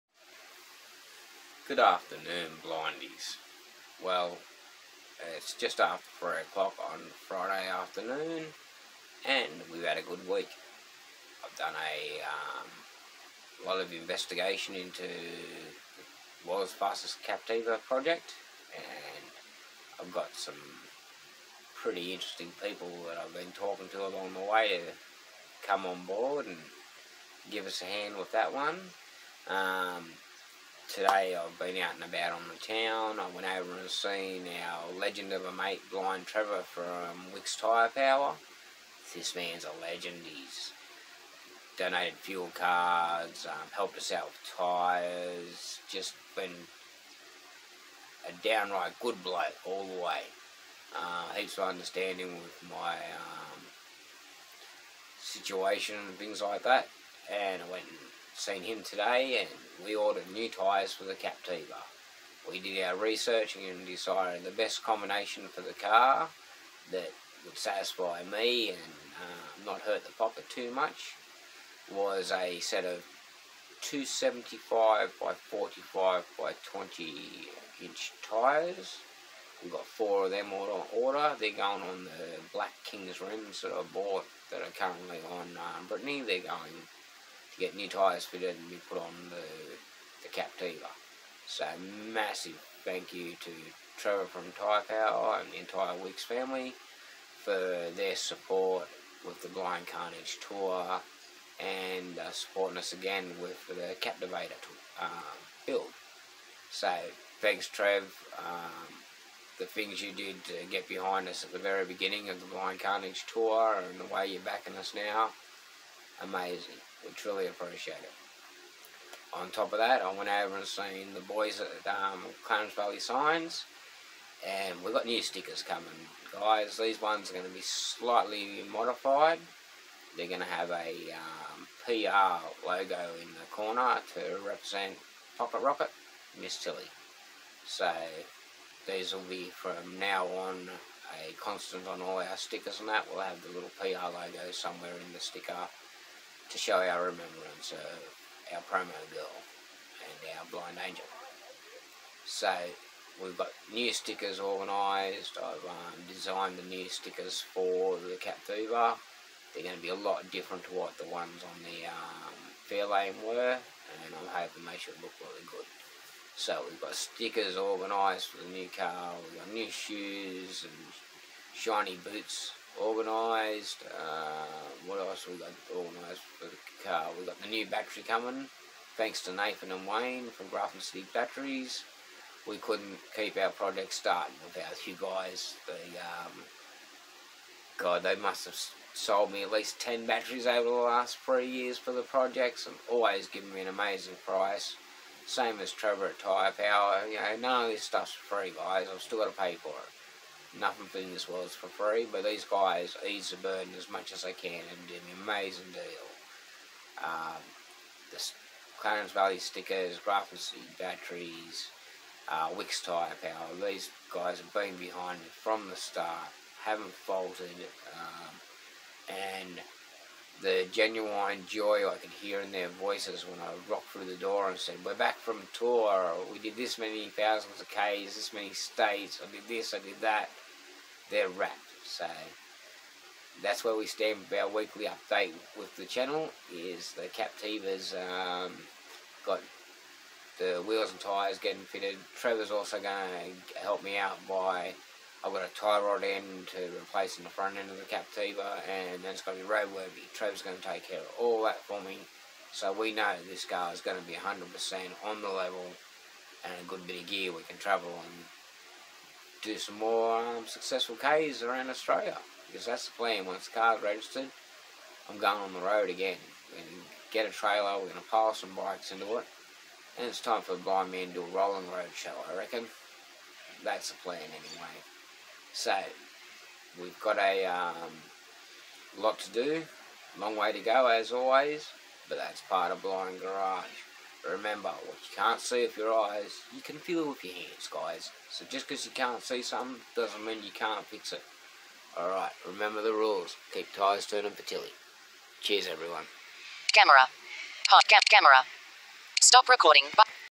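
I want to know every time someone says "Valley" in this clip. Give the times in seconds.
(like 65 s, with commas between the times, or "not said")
122 s, 209 s.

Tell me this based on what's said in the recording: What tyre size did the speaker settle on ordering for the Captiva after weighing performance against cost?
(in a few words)
275 by 45 by 20 inch.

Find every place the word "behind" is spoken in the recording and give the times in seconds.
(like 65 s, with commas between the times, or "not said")
110 s, 214 s.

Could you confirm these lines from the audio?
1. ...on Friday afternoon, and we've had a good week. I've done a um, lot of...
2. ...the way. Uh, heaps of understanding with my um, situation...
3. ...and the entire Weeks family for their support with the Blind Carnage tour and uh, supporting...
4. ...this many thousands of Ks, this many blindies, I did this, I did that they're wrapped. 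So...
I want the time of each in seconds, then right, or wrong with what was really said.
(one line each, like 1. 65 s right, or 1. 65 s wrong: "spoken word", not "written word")
1. 6 s right
2. 49 s right
3. 95 s right
4. 226 s wrong: "states", not "blindies".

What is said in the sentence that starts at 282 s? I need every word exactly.
But that's part of Blind Garage.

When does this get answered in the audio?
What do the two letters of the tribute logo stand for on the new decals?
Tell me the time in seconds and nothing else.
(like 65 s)
135 s.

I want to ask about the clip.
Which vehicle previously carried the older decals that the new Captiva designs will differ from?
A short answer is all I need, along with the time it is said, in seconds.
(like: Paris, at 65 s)
Fairlane, at 162 s.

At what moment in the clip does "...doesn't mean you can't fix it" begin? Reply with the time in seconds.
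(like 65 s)
289 s.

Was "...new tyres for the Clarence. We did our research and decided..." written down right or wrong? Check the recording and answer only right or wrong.
wrong.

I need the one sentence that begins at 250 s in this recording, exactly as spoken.
Trevor's going to take care of all that for me.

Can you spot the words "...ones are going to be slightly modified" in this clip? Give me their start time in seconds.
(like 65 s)
127 s.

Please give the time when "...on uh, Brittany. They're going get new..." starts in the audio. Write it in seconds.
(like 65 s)
85 s.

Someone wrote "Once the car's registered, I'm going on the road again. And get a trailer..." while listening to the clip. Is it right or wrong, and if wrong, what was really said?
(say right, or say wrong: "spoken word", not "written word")
right.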